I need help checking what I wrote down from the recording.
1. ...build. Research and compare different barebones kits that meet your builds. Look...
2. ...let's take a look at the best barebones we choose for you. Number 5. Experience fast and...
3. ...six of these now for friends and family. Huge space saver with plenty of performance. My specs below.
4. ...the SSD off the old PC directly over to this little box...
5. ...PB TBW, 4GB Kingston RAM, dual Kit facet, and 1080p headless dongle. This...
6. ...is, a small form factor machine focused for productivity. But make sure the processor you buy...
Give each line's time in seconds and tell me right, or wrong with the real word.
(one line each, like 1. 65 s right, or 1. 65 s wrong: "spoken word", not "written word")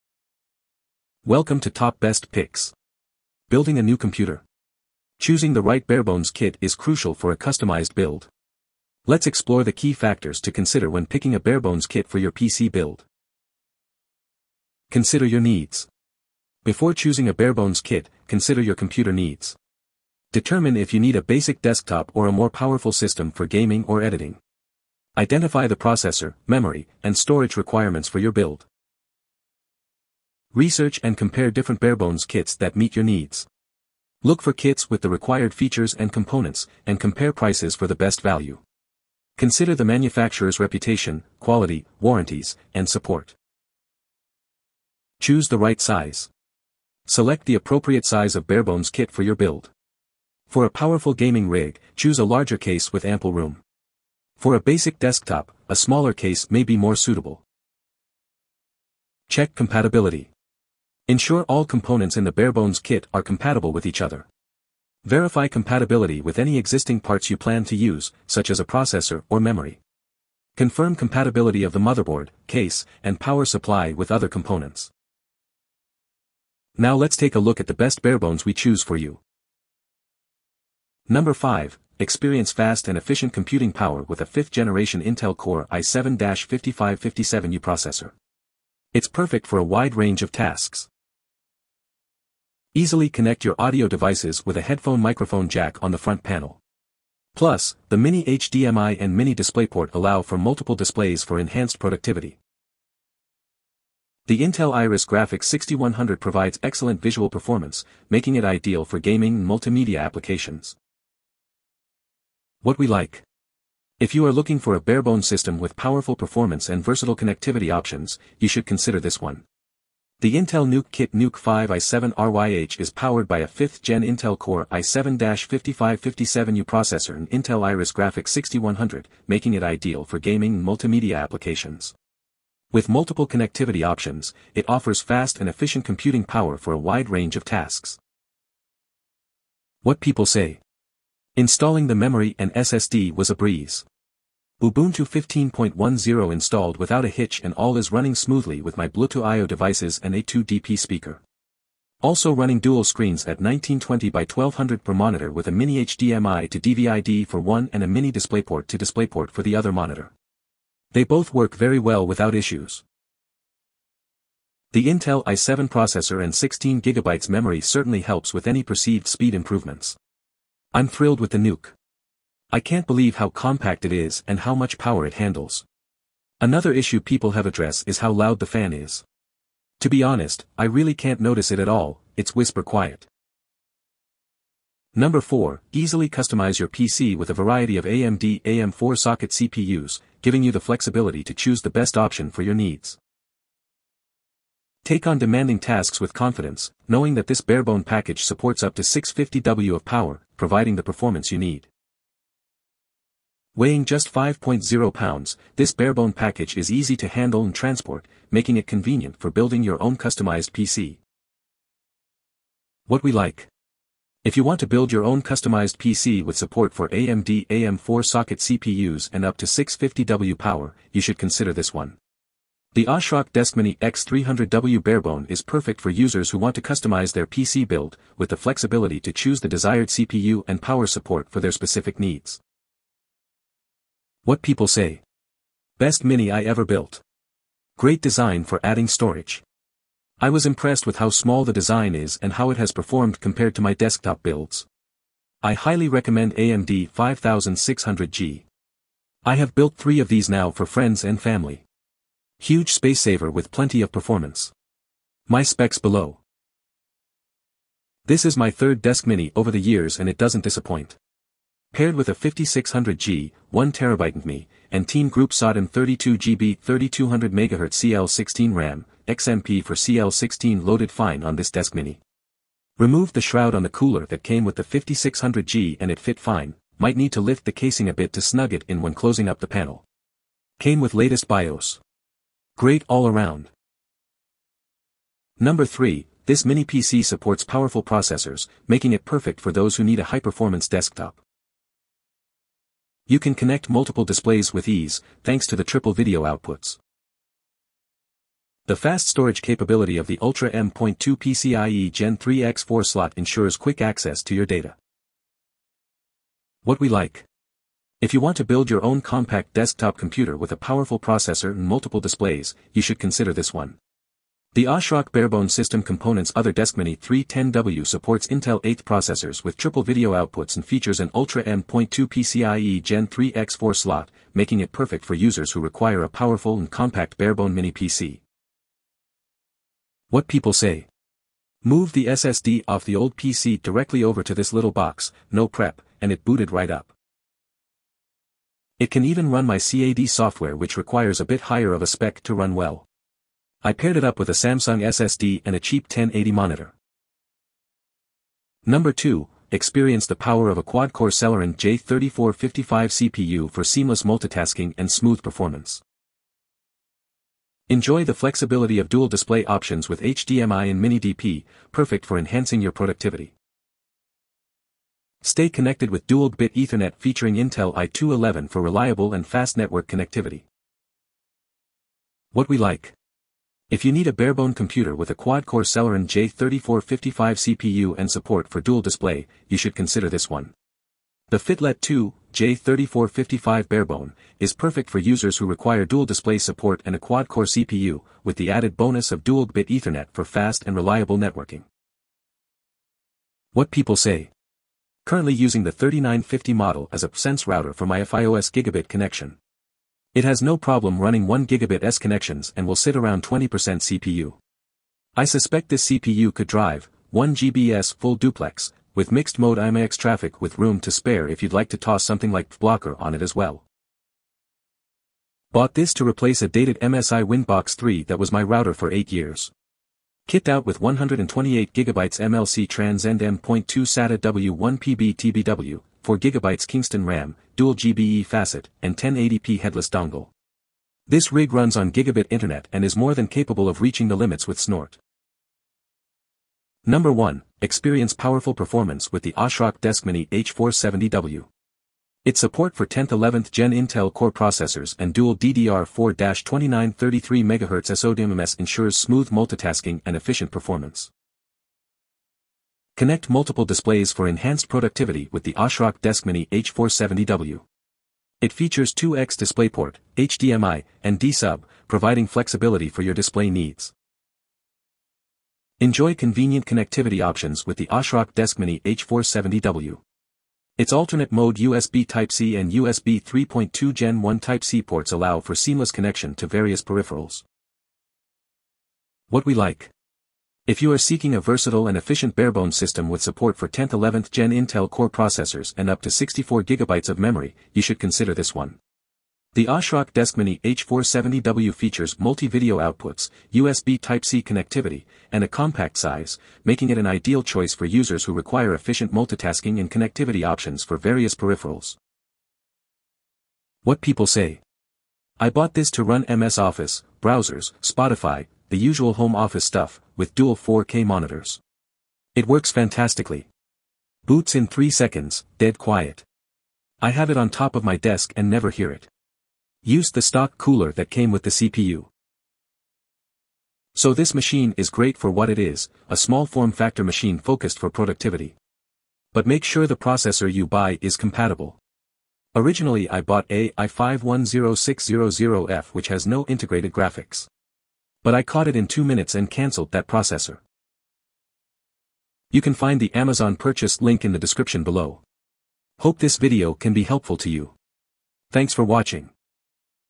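1. 28 s wrong: "needs", not "builds"
2. 76 s right
3. 249 s wrong: "three", not "six"
4. 331 s right
5. 424 s wrong: "GBE", not "Kit"
6. 525 s right.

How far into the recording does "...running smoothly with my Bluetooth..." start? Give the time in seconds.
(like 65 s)
147 s.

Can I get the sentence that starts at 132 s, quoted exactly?
With multiple connectivity options, it offers fast and efficient computing power for a wide range of tasks.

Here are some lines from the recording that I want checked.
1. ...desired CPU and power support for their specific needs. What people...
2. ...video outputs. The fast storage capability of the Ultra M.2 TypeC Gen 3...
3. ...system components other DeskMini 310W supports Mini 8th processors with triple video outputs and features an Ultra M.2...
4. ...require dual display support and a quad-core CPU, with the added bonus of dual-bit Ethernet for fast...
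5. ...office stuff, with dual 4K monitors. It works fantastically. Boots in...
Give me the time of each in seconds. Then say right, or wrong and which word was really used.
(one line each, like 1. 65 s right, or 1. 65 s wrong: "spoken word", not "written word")
1. 229 s right
2. 295 s wrong: "PCIe", not "TypeC"
3. 315 s wrong: "Intel", not "Mini"
4. 385 s right
5. 509 s right.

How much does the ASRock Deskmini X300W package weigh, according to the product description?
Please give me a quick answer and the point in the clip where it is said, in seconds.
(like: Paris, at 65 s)
5.0 pounds, at 204 s.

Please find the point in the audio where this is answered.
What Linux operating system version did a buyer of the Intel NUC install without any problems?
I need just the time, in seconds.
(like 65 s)
144 s.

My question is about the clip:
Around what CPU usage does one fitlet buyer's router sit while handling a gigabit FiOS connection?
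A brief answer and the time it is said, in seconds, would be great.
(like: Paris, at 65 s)
20%, at 403 s.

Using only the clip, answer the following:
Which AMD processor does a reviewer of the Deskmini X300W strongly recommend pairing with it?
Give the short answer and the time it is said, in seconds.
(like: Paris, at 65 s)
AMD 5600G, at 246 s.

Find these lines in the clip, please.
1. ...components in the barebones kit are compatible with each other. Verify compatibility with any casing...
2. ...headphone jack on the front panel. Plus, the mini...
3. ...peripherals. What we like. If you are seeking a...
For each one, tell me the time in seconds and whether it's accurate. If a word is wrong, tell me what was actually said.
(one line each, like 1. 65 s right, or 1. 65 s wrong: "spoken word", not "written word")
1. 61 s wrong: "existing", not "casing"
2. 95 s wrong: "microphone", not "headphone"
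3. 476 s right.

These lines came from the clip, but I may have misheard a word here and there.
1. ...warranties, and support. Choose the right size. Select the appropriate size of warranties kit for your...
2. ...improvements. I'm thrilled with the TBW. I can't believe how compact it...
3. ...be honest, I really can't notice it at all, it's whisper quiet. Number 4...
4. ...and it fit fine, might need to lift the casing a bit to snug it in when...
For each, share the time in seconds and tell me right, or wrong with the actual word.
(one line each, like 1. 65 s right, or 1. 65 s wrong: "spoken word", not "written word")
1. 42 s wrong: "barebones", not "warranties"
2. 169 s wrong: "NUC", not "TBW"
3. 179 s right
4. 275 s right.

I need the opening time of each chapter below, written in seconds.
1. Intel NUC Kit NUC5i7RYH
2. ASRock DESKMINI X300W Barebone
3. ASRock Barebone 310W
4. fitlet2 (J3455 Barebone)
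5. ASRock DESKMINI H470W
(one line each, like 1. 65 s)
1. 79 s
2. 183 s
3. 284 s
4. 347 s
5. 435 s.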